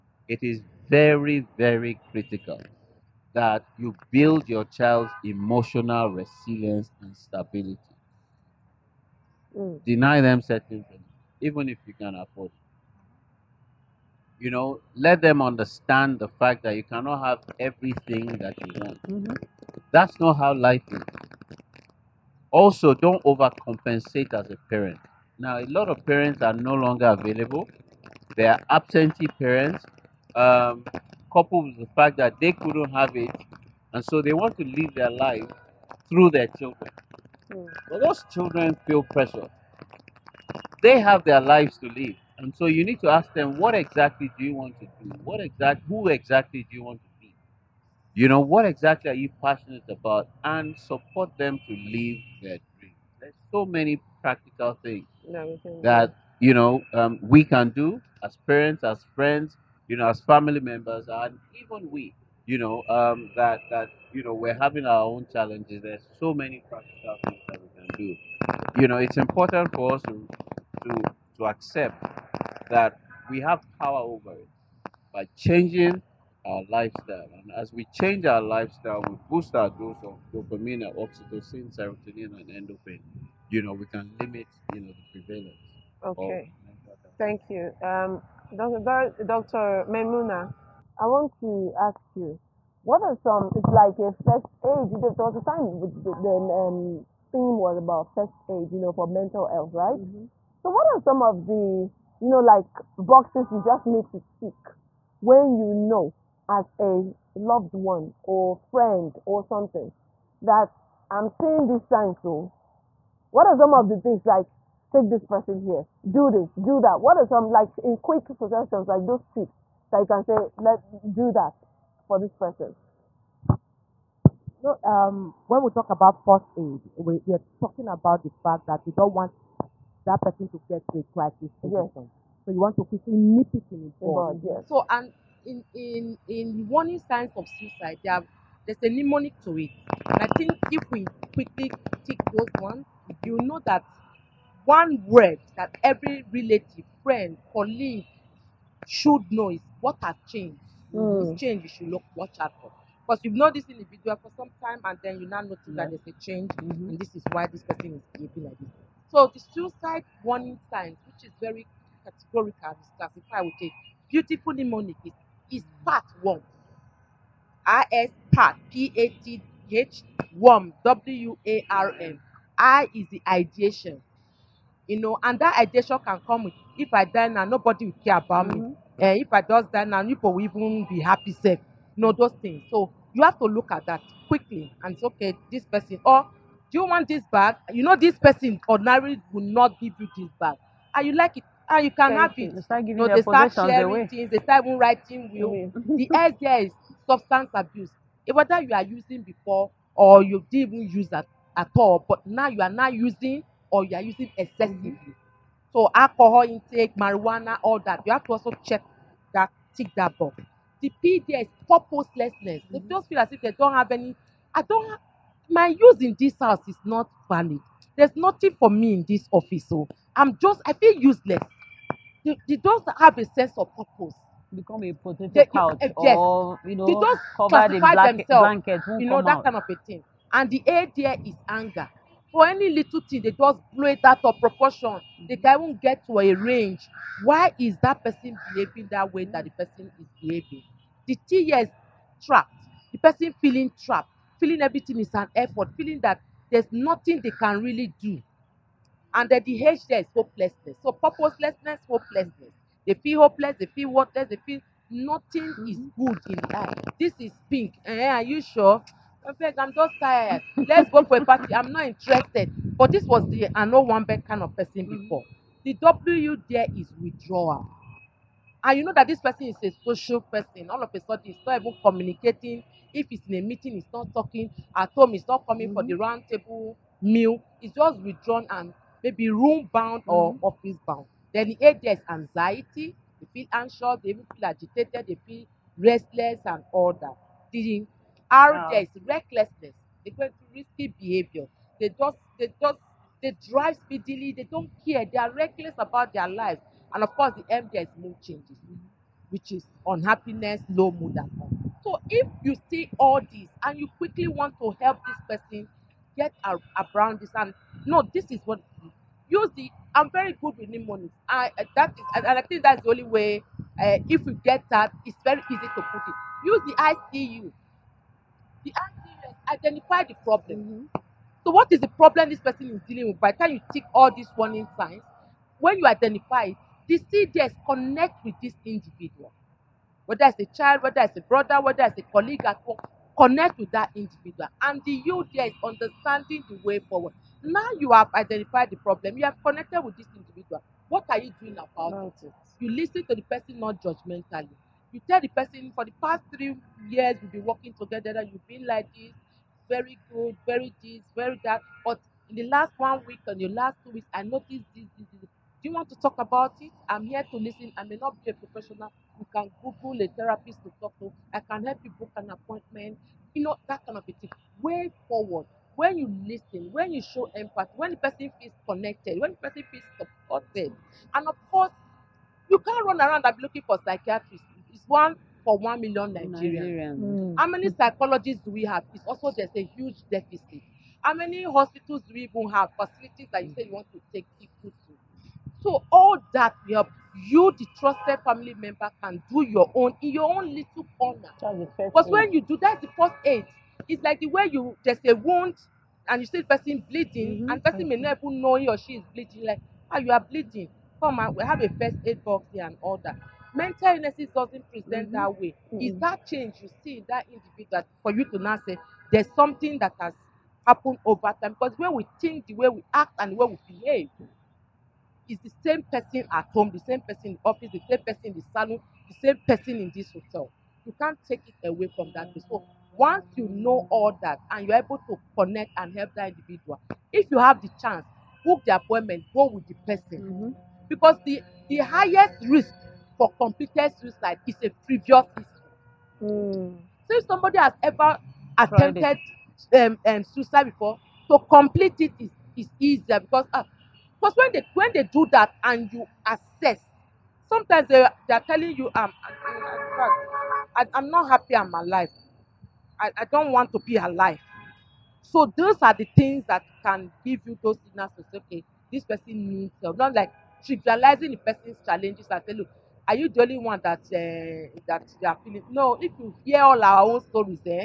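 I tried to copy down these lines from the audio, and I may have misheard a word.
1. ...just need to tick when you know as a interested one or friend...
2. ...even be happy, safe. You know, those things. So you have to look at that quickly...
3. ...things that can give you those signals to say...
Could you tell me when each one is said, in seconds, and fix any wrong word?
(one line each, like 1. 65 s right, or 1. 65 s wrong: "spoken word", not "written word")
1. 103 s wrong: "loved", not "interested"
2. 180 s right
3. 456 s right.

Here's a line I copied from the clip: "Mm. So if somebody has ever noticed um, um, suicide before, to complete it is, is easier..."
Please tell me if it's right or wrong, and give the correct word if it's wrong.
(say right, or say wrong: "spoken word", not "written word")
wrong: "attempted", not "noticed".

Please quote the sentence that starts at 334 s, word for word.
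And the you there is understanding the way forward.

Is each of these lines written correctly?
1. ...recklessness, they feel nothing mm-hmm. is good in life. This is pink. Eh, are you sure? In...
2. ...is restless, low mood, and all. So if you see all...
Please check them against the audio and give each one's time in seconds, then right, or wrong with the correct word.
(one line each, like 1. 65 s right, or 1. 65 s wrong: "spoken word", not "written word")
1. 253 s wrong: "worthless", not "recklessness"
2. 299 s wrong: "unhappiness", not "restless".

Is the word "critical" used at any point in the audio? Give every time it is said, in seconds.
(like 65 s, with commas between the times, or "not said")
2 s.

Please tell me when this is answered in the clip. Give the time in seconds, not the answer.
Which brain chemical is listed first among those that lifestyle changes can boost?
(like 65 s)
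80 s.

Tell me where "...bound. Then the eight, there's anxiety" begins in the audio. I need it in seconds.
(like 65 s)
280 s.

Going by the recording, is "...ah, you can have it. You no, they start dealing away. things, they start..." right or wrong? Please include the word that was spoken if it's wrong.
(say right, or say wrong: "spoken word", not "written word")
wrong: "sharing", not "dealing".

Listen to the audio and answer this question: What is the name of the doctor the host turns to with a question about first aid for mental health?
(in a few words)
Memuna.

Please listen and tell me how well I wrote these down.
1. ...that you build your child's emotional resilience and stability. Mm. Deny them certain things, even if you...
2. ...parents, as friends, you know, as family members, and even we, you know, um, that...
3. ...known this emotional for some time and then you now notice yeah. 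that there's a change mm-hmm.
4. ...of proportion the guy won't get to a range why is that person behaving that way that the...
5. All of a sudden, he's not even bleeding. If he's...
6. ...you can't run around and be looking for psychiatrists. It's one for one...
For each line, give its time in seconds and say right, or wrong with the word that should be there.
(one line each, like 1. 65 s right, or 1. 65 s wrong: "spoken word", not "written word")
1. 3 s right
2. 58 s right
3. 153 s wrong: "individual", not "emotional"
4. 234 s right
5. 270 s wrong: "communicating", not "bleeding"
6. 372 s right.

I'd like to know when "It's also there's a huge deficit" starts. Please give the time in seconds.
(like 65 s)
378 s.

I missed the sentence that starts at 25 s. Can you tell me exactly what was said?
Now, a lot of parents are no longer available.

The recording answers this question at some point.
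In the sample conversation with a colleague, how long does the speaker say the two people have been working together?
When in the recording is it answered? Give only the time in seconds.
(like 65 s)
346 s.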